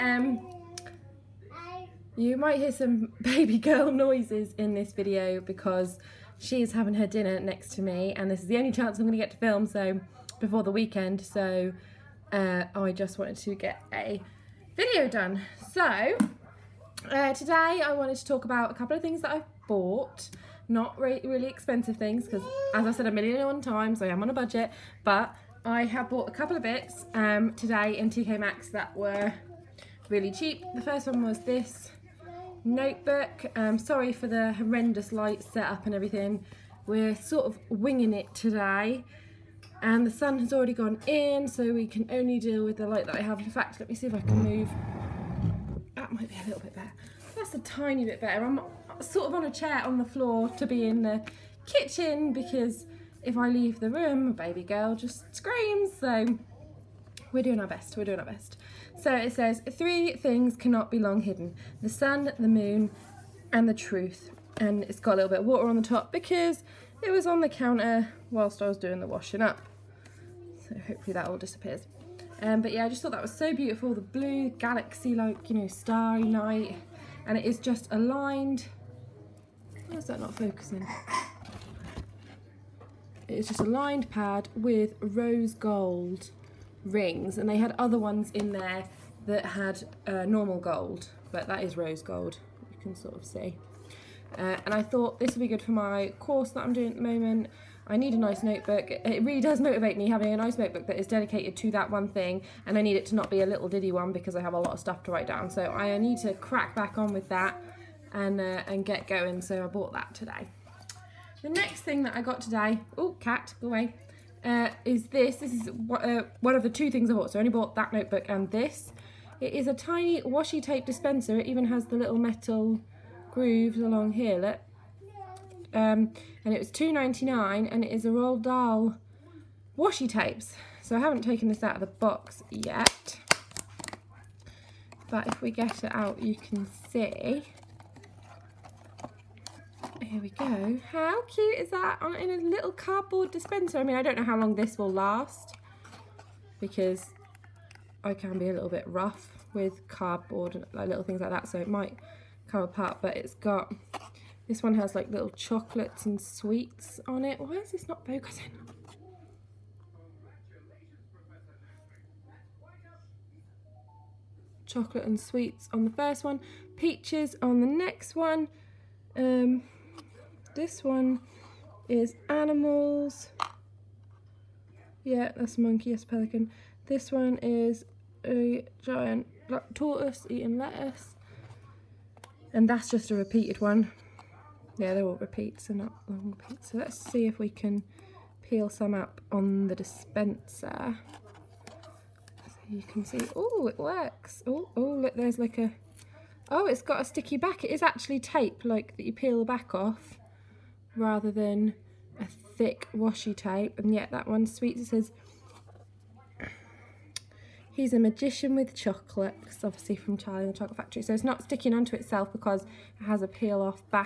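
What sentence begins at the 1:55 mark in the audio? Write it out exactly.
This is uh, one of the two things I bought, so I only bought that notebook and um, this.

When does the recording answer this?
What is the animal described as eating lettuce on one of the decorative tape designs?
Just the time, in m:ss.
2:58.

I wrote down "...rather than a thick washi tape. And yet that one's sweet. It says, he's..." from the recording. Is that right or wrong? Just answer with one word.
right.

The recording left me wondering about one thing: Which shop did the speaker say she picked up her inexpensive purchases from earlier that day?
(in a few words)
TK Maxx.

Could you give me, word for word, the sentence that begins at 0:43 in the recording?
In fact, let me see if I can move.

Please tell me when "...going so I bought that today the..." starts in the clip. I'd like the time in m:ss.
1:49.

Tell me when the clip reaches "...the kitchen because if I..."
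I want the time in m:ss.
0:51.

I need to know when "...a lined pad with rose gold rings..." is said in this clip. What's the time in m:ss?
1:23.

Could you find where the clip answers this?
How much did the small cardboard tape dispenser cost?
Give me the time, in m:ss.
2:06.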